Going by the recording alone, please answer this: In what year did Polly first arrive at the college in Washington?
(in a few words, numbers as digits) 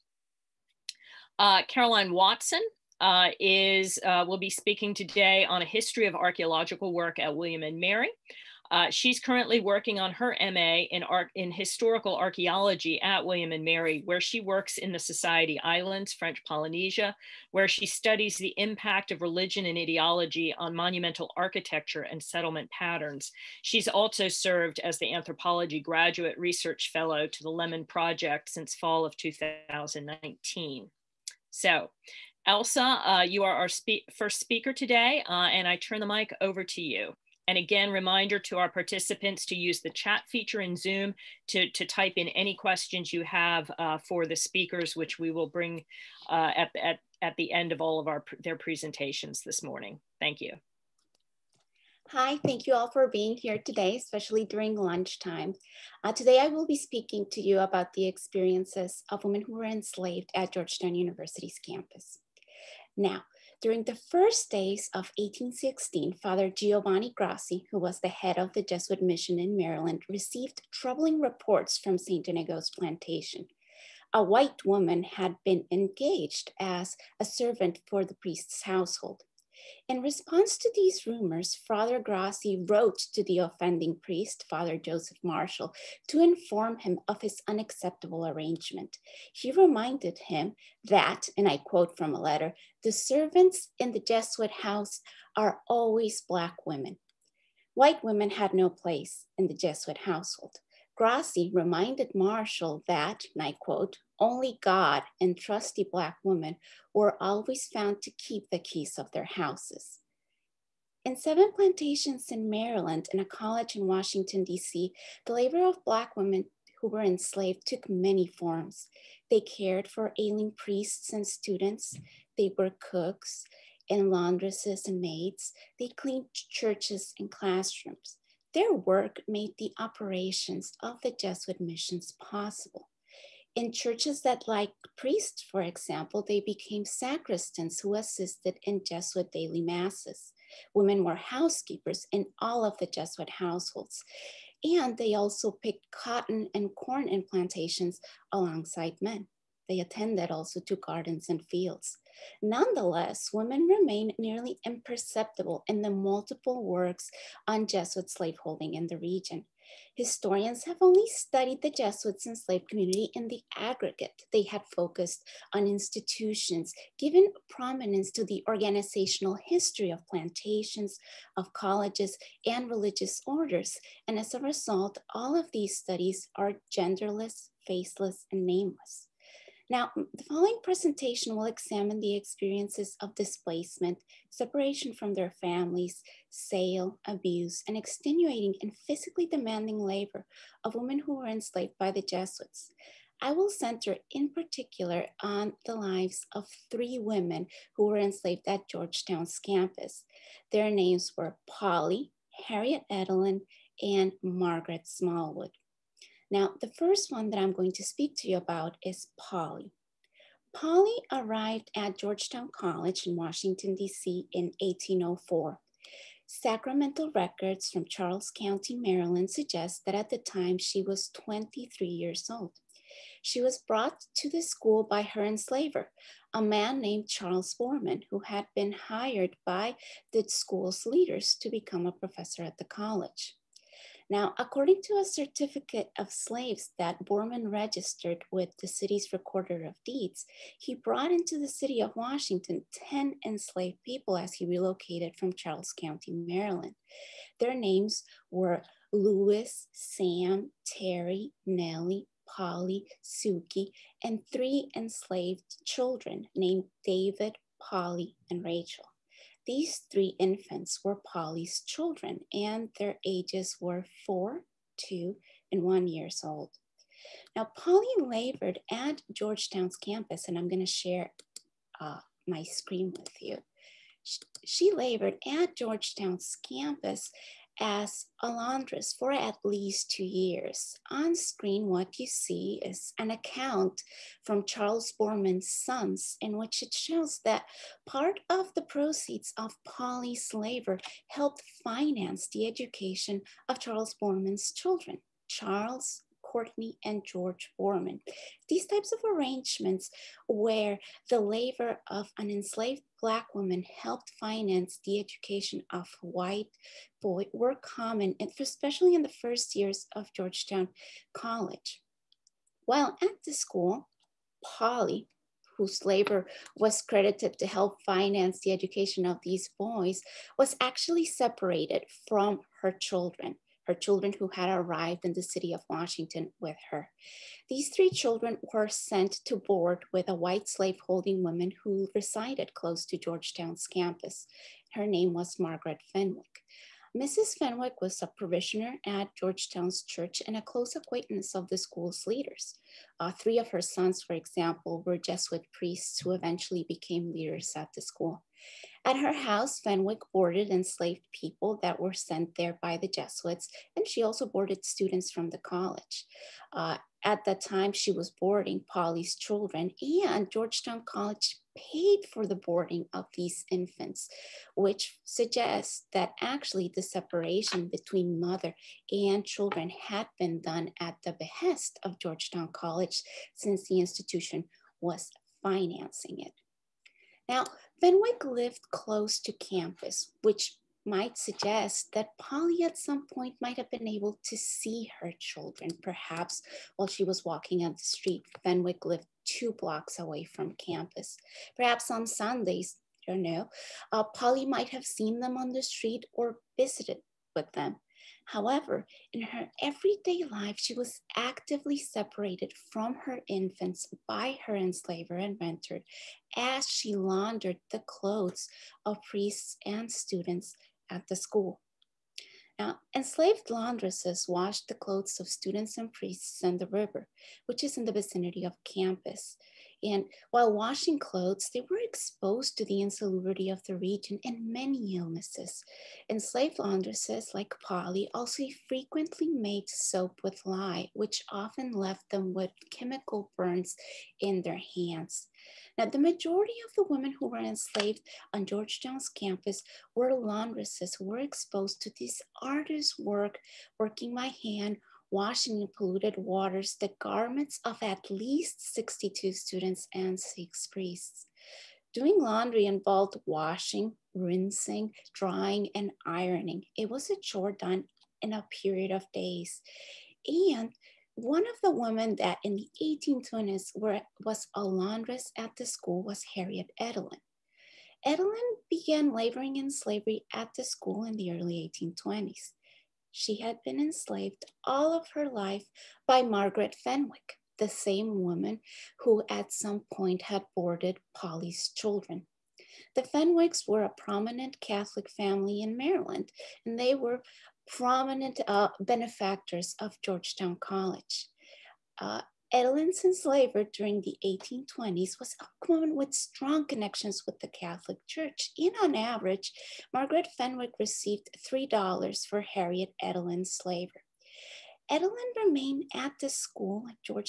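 1804.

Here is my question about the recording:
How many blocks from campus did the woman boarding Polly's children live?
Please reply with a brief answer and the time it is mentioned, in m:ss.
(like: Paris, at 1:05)
2, at 6:29.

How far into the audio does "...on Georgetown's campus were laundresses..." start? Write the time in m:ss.
7:18.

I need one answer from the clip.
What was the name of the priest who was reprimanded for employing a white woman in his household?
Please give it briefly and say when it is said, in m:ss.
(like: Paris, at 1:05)
Joseph Marshall, at 1:24.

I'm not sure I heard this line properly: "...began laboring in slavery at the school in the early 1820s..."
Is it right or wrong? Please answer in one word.
right.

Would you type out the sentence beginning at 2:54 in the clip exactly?
And as a result, all of these studies are genderless, faceless, and nameless.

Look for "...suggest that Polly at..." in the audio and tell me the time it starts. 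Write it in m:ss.
6:21.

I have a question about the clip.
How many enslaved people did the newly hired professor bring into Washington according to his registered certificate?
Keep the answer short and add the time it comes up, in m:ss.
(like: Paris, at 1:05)
10, at 4:02.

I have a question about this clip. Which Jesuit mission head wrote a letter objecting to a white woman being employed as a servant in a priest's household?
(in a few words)
Giovanni Grassi.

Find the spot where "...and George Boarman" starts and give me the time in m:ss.
4:56.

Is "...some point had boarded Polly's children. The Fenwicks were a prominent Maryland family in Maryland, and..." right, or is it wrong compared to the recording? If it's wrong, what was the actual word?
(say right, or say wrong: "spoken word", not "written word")
wrong: "Catholic", not "Maryland".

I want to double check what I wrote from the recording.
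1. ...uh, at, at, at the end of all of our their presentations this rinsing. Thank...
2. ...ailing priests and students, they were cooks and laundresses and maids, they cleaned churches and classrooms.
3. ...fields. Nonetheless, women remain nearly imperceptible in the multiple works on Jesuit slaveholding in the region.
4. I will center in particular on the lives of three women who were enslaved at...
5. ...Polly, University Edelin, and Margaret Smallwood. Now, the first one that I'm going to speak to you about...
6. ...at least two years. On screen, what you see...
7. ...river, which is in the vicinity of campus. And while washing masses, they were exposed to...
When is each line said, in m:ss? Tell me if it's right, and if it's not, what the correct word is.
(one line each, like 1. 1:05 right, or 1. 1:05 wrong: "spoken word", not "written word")
1. 0:46 wrong: "morning", not "rinsing"
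2. 2:00 right
3. 2:31 right
4. 3:13 right
5. 3:21 wrong: "Harriet", not "University"
6. 4:39 right
7. 6:56 wrong: "clothes", not "masses".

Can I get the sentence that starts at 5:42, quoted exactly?
Uh, three of her sons, for example, were Jesuit priests who eventually became leaders at the school.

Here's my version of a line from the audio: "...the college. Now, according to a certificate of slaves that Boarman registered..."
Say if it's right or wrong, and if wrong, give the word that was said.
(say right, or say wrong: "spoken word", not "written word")
right.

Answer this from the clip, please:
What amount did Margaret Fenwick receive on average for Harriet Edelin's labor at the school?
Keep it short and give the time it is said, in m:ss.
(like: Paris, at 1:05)
$3, at 8:21.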